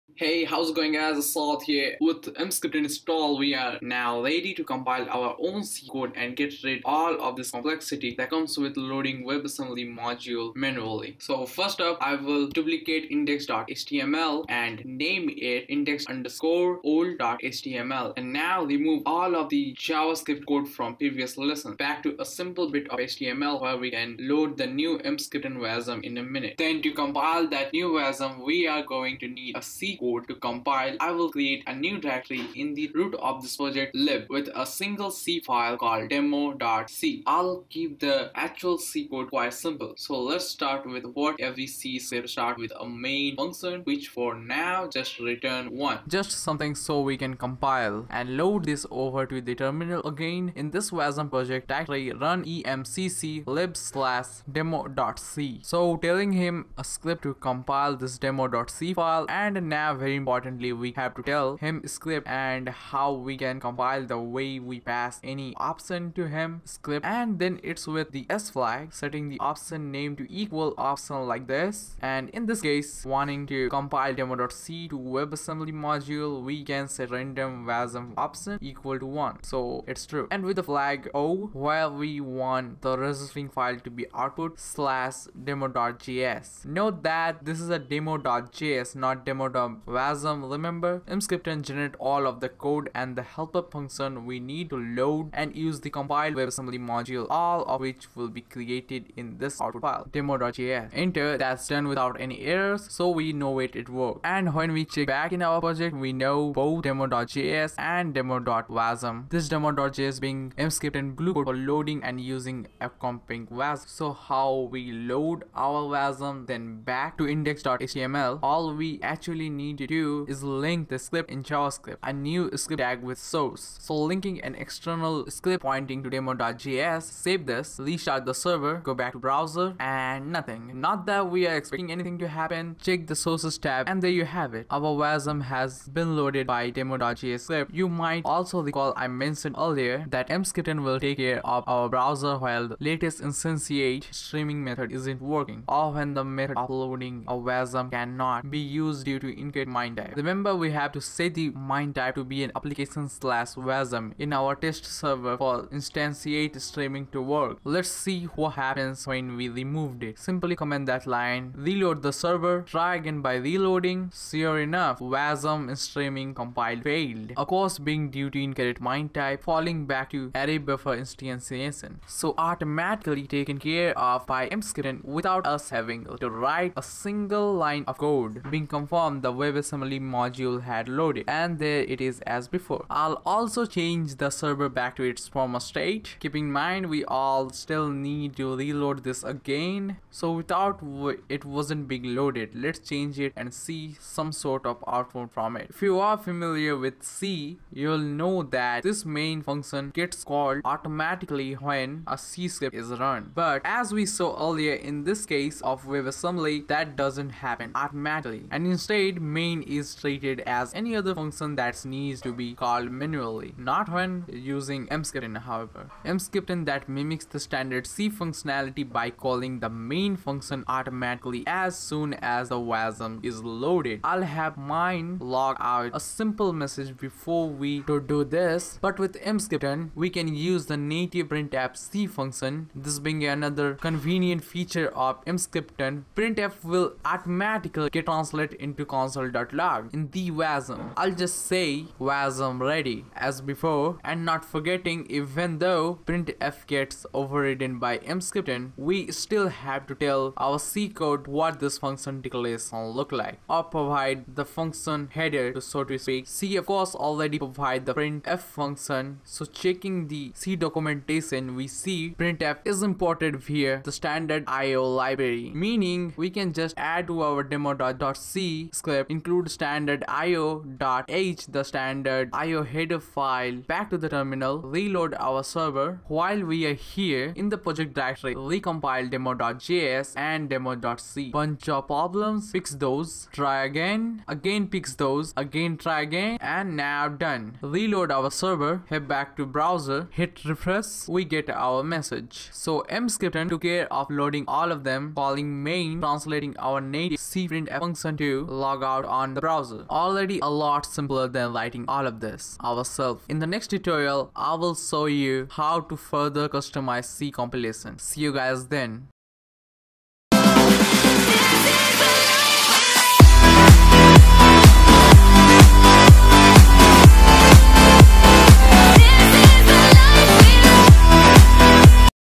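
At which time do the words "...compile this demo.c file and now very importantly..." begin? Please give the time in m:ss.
0:57.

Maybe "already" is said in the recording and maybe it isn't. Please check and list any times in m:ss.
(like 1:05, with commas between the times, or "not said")
4:16, 4:59.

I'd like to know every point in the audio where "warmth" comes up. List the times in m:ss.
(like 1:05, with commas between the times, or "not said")
not said.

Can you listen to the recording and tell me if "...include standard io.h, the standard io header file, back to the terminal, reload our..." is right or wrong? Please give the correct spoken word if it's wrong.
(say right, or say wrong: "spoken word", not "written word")
right.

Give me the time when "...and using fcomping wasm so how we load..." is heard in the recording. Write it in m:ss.
1:52.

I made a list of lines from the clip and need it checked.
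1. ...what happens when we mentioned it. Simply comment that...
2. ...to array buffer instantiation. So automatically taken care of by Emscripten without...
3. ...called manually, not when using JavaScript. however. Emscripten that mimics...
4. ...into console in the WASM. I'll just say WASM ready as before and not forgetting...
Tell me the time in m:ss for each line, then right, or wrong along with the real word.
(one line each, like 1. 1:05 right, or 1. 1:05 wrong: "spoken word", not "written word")
1. 2:38 wrong: "removed", not "mentioned"
2. 2:50 right
3. 3:32 wrong: "Emscripten", not "JavaScript"
4. 3:58 right.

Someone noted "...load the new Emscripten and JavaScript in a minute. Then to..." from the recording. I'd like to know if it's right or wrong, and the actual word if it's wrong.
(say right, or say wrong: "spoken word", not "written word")
wrong: "WASM", not "JavaScript".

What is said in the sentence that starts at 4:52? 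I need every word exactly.
So Emscripten took care of loading all of them, calling main, translating our native cprintf function to log out on the browser.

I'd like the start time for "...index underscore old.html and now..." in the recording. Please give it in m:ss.
0:15.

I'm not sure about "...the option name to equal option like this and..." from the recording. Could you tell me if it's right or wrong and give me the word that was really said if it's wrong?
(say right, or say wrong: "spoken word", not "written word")
right.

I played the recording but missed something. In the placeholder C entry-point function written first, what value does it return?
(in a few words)
1.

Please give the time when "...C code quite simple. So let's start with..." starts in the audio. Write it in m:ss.
0:38.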